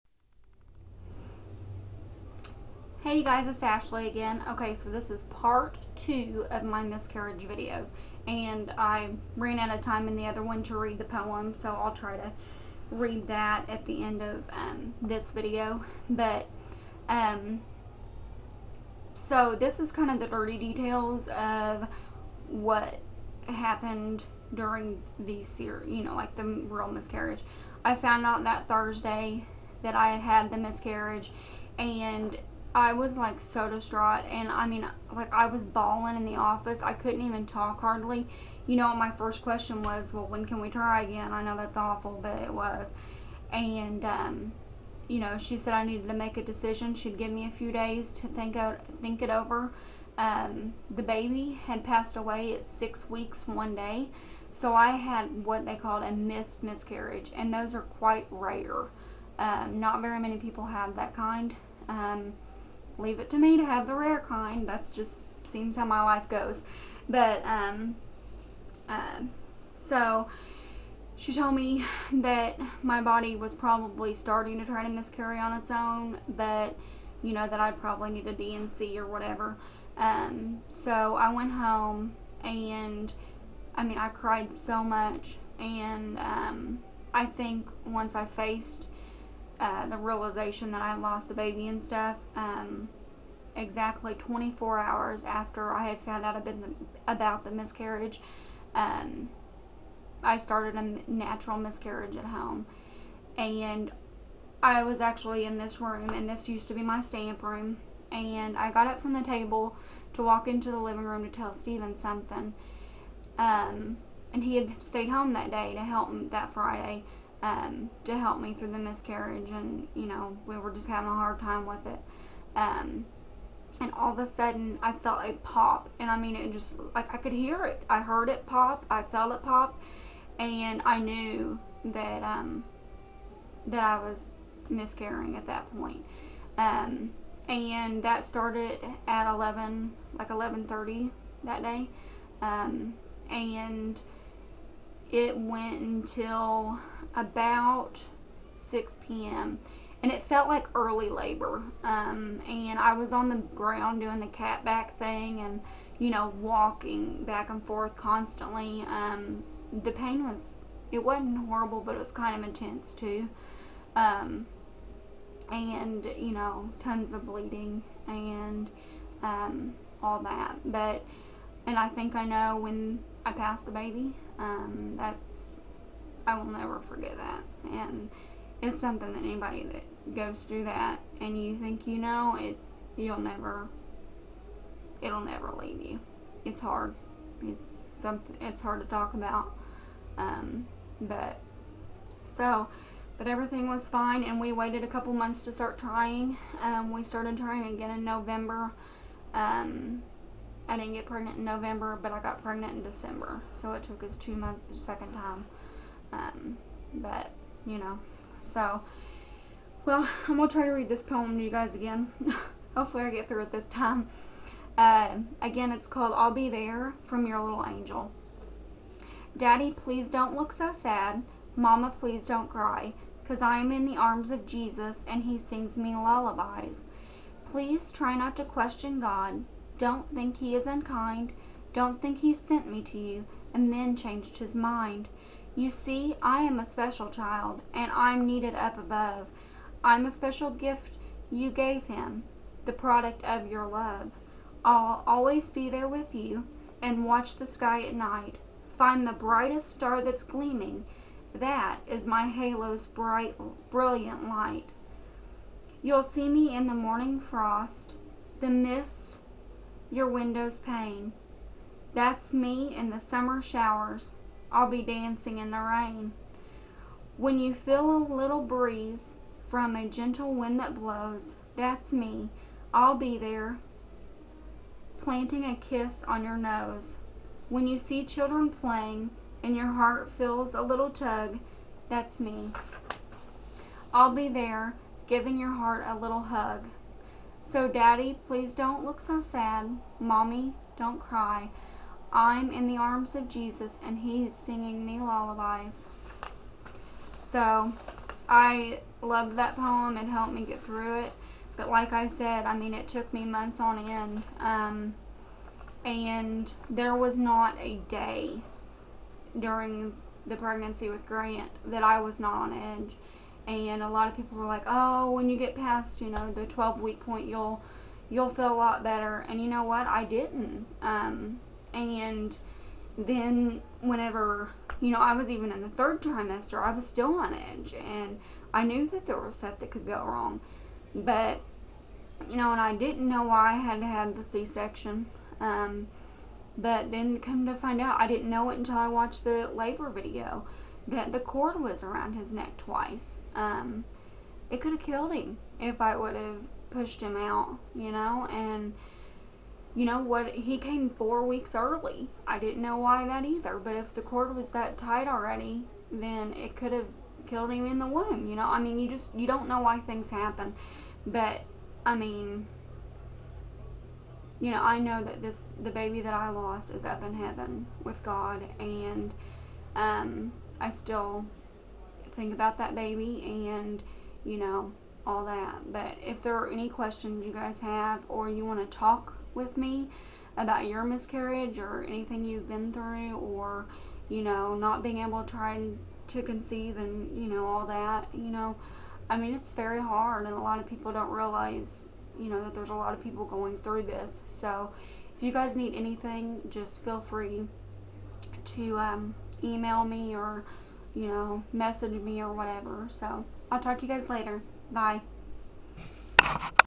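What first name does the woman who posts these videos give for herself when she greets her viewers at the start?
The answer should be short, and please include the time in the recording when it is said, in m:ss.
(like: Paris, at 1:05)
Ashley, at 0:03.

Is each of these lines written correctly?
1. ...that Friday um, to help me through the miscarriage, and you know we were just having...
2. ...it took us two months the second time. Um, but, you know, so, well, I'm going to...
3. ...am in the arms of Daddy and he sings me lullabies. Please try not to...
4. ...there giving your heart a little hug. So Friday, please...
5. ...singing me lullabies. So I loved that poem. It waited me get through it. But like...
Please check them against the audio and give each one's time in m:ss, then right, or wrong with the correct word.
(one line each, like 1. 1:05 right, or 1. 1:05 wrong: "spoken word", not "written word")
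1. 1:56 right
2. 3:23 right
3. 3:43 wrong: "Jesus", not "Daddy"
4. 4:44 wrong: "Daddy", not "Friday"
5. 4:54 wrong: "helped", not "waited".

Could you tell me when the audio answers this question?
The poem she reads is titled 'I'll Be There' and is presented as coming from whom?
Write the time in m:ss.
3:37.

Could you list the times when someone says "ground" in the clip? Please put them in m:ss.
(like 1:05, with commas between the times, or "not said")
2:33.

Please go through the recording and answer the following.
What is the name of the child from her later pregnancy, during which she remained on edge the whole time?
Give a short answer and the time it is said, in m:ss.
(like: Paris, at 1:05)
Grant, at 5:11.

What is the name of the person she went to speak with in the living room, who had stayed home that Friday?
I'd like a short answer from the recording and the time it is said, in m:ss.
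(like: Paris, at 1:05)
Steven, at 1:51.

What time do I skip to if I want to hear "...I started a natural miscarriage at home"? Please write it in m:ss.
1:40.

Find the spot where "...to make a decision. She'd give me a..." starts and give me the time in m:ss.
0:46.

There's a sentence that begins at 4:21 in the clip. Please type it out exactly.
That's me in the summer showers, I'll be dancing in the rain.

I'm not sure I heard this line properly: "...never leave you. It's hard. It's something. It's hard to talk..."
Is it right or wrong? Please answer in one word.
right.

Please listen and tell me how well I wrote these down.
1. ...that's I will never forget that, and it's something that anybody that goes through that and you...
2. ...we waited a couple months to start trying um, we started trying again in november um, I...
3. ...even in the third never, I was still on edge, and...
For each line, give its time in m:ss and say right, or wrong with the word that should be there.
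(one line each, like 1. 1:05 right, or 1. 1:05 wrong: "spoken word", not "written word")
1. 2:54 right
2. 3:14 right
3. 5:25 wrong: "trimester", not "never".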